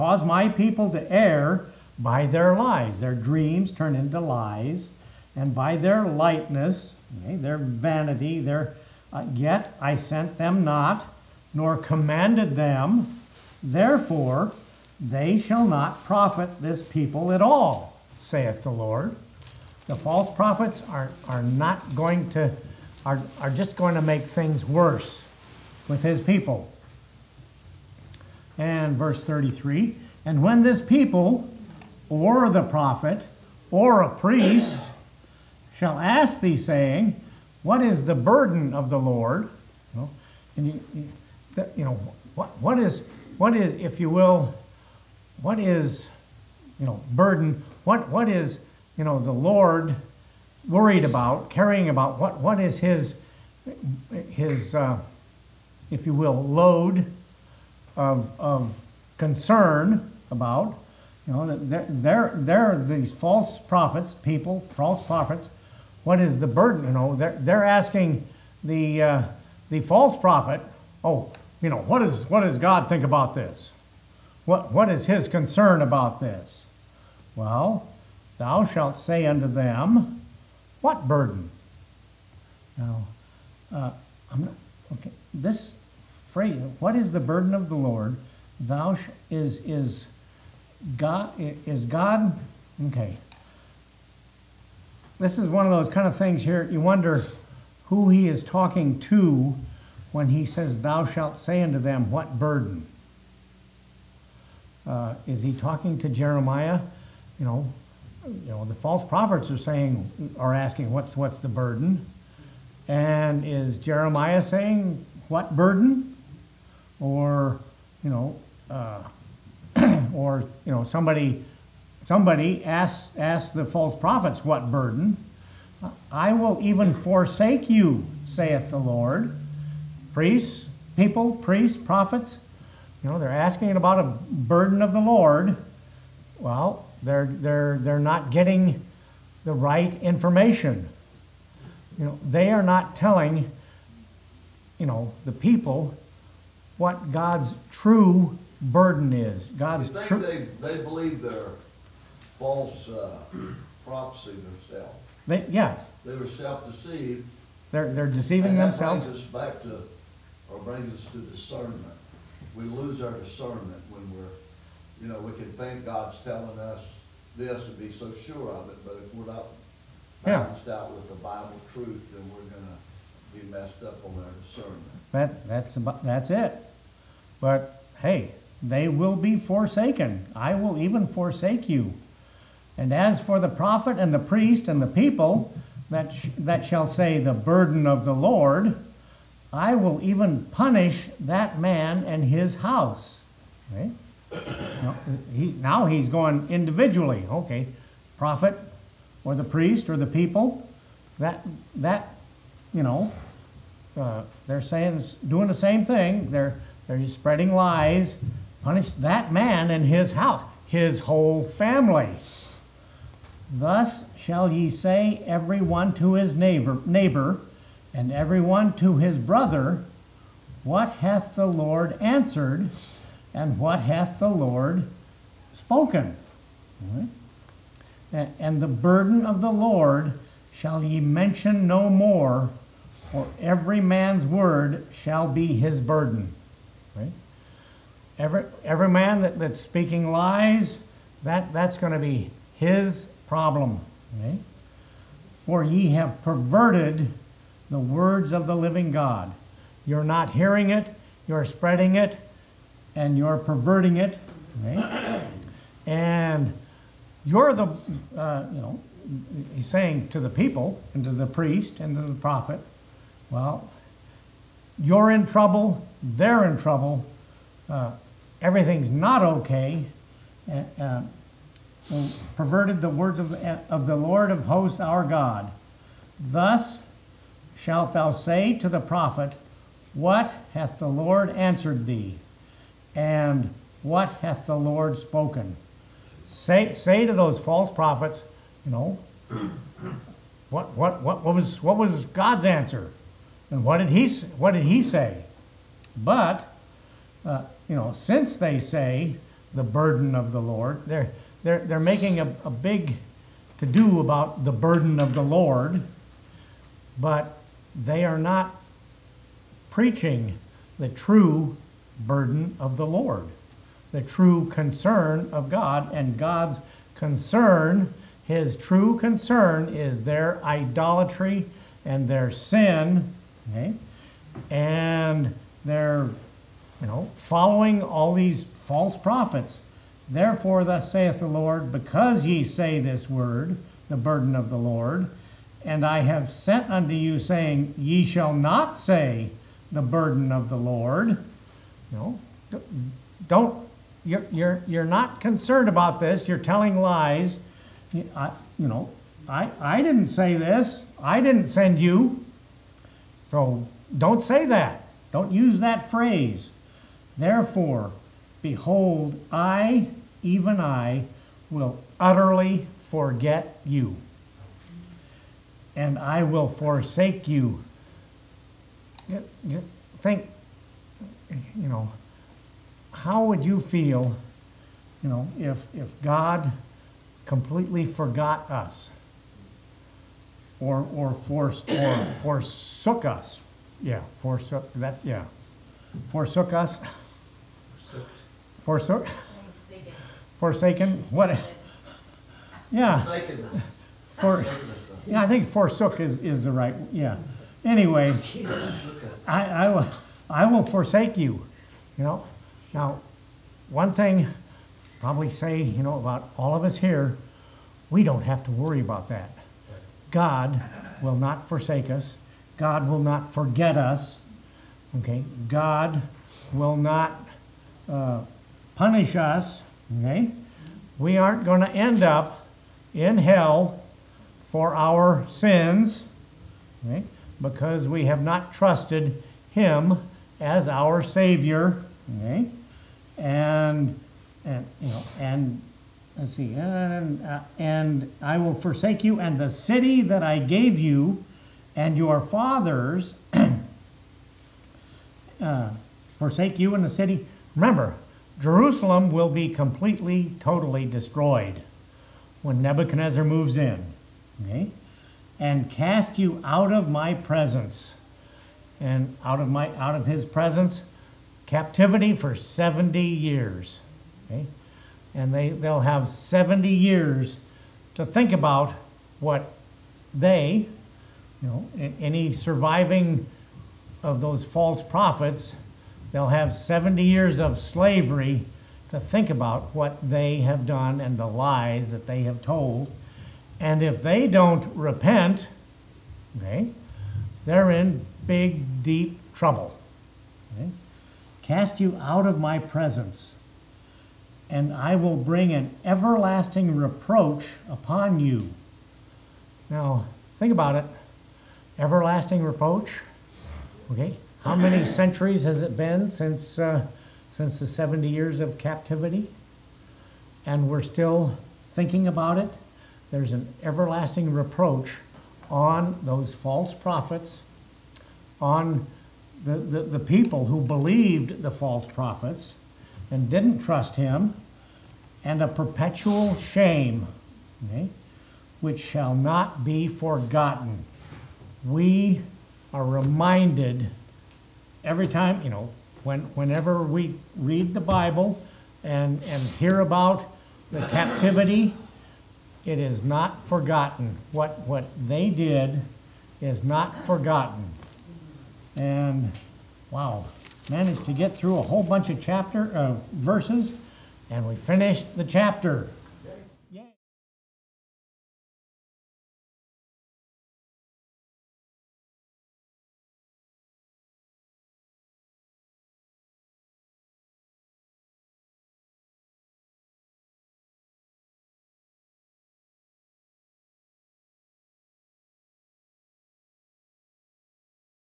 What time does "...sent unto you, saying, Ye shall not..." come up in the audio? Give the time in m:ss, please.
5:36.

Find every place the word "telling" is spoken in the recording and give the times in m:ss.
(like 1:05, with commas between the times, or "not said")
2:22, 2:46, 5:46.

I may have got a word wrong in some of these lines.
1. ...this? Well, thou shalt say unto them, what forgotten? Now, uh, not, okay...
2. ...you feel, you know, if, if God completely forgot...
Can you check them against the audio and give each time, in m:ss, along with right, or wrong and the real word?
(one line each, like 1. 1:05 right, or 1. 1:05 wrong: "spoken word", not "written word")
1. 1:16 wrong: "burden", not "forgotten"
2. 6:13 right.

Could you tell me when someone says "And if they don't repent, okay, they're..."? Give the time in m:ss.
8:03.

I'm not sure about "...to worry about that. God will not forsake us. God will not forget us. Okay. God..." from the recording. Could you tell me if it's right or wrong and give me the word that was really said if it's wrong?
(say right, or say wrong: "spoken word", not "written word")
right.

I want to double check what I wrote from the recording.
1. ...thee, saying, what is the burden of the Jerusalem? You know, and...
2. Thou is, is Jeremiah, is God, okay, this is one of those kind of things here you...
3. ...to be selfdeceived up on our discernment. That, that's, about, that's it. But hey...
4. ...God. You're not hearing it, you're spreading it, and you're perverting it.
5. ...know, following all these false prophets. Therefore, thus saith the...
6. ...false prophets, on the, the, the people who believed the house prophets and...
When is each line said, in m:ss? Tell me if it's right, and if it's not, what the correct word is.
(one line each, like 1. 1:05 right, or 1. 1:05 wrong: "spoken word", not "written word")
1. 0:36 wrong: "Lord", not "Jerusalem"
2. 1:28 wrong: "God", not "Jeremiah"
3. 2:52 wrong: "messed", not "selfdeceived"
4. 4:08 right
5. 5:26 right
6. 8:36 wrong: "false", not "house".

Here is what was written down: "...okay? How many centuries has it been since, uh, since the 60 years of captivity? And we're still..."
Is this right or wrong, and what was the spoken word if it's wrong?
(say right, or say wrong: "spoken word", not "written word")
wrong: "70", not "60".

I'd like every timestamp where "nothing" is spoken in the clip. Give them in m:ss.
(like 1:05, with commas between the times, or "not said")
not said.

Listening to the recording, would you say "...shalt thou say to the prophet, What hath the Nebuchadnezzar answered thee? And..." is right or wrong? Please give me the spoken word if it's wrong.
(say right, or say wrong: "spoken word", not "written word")
wrong: "Lord", not "Nebuchadnezzar".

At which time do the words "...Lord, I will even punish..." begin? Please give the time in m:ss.
3:08.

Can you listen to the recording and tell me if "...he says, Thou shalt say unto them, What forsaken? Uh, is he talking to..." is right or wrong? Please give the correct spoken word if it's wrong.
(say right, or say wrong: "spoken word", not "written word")
wrong: "burden", not "forsaken".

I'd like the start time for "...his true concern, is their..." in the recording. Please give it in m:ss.
5:18.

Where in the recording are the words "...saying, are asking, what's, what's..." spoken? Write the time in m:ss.
1:49.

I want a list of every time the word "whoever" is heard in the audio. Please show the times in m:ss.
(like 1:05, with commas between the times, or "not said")
not said.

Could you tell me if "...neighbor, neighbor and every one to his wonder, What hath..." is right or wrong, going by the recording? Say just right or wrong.
wrong.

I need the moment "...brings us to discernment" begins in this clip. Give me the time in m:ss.
2:40.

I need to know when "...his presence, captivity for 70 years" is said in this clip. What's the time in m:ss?
7:40.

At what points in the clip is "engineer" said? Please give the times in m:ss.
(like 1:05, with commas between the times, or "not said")
not said.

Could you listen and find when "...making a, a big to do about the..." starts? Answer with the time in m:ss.
5:01.